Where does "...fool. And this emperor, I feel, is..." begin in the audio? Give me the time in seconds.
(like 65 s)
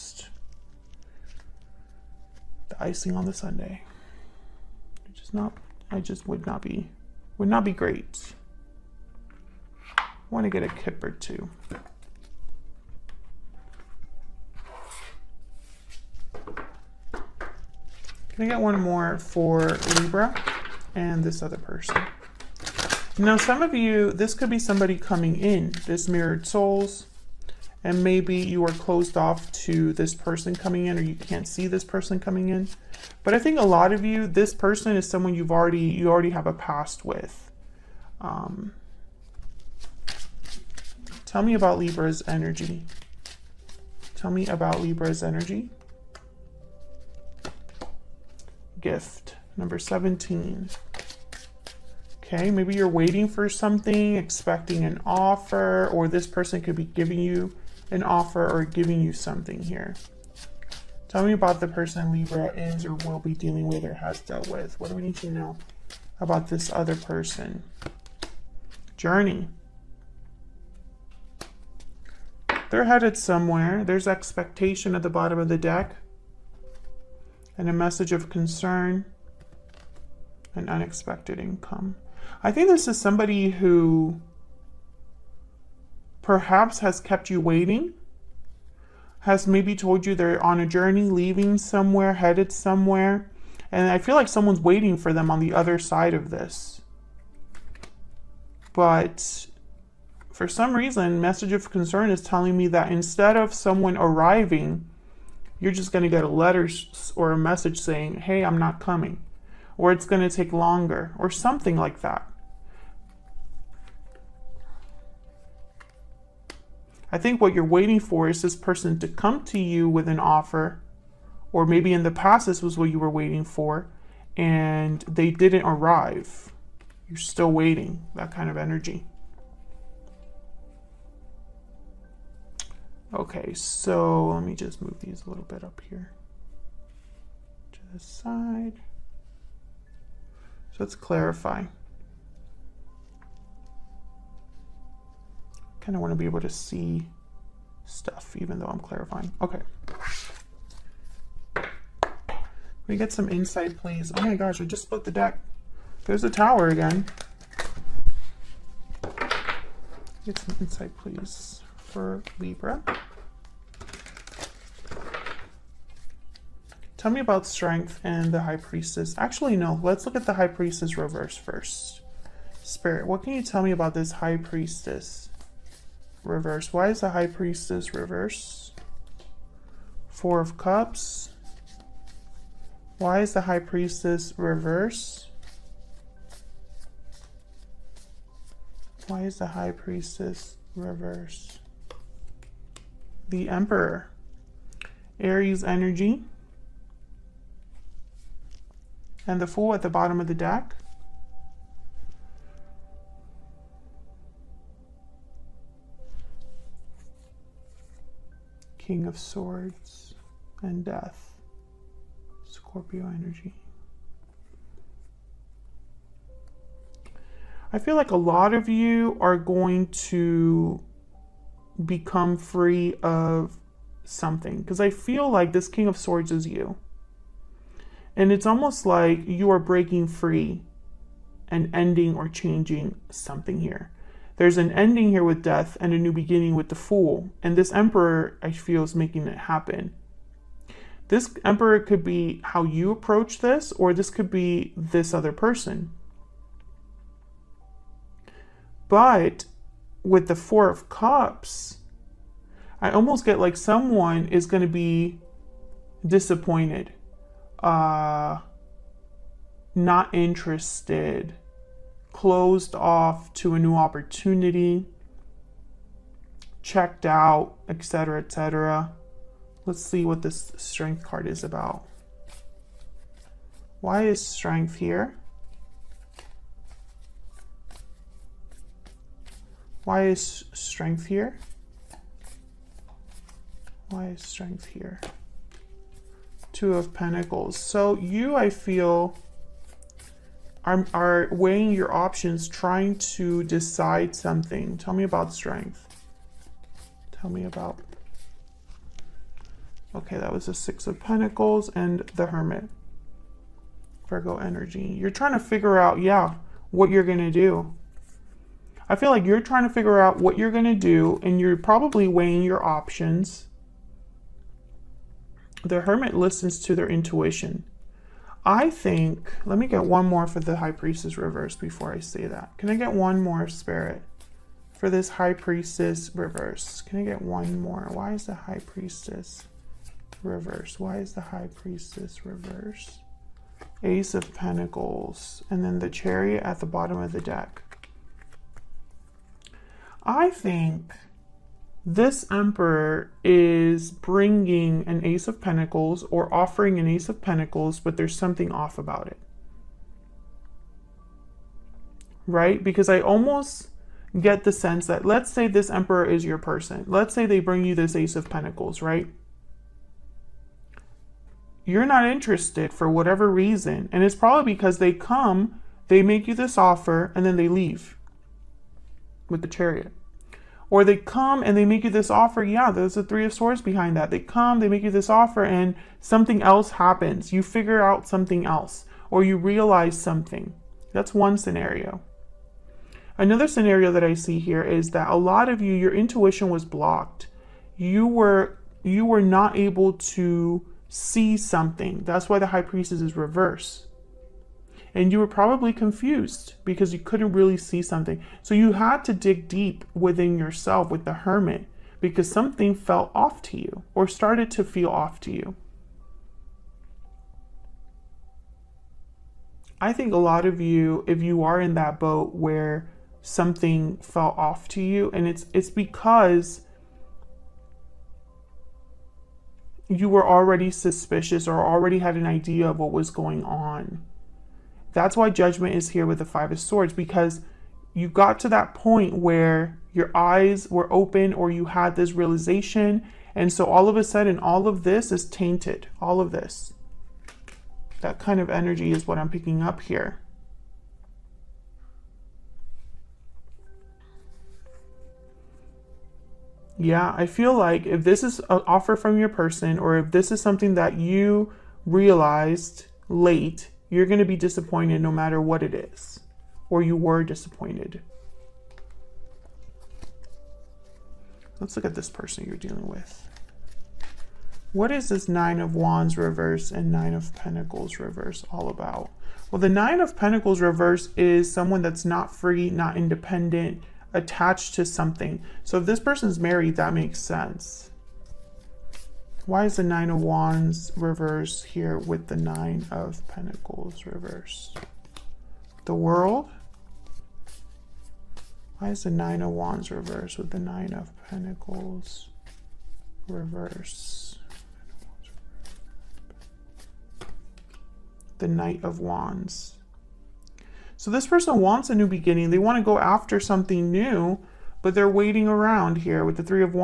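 236 s.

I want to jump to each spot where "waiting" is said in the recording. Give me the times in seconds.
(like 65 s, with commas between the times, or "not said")
52 s, 87 s, 94 s, 117 s, 123 s, 127 s, 505 s.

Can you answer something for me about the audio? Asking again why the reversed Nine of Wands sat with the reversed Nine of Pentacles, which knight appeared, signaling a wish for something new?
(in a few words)
Knight of Wands.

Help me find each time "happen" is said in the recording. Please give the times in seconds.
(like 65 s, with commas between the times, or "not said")
239 s, 376 s.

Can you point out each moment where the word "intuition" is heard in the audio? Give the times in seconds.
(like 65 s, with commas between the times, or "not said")
316 s, 385 s.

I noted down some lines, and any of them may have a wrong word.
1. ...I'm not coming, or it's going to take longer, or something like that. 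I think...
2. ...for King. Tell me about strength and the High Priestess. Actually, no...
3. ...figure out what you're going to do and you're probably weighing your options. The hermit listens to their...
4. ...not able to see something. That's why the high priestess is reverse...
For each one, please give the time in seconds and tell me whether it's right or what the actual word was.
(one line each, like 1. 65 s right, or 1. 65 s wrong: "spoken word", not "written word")
1. 108 s right
2. 161 s wrong: "Libra", not "King"
3. 309 s right
4. 389 s right.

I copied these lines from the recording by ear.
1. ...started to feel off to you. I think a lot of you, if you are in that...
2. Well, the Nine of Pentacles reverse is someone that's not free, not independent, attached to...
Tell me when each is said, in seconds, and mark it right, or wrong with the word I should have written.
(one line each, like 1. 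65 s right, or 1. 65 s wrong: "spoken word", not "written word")
1. 404 s right
2. 469 s right.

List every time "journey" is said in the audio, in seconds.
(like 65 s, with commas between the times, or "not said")
68 s, 90 s.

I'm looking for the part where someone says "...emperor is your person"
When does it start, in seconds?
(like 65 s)
355 s.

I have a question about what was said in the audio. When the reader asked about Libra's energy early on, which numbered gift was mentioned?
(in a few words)
17.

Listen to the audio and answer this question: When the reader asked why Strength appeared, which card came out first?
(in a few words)
Two of Pentacles.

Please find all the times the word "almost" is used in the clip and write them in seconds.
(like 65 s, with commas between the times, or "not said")
228 s, 252 s, 352 s.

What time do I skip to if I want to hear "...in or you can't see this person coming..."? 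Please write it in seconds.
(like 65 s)
30 s.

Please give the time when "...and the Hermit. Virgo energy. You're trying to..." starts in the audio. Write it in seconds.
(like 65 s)
301 s.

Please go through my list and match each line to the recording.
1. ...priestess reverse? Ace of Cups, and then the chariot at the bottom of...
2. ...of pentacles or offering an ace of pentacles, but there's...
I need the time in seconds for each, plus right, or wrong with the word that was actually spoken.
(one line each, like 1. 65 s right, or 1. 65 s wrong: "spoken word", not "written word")
1. 331 s wrong: "Pentacles", not "Cups"
2. 345 s right.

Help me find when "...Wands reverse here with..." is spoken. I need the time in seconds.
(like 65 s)
480 s.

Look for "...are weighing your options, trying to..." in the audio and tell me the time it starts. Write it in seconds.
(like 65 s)
290 s.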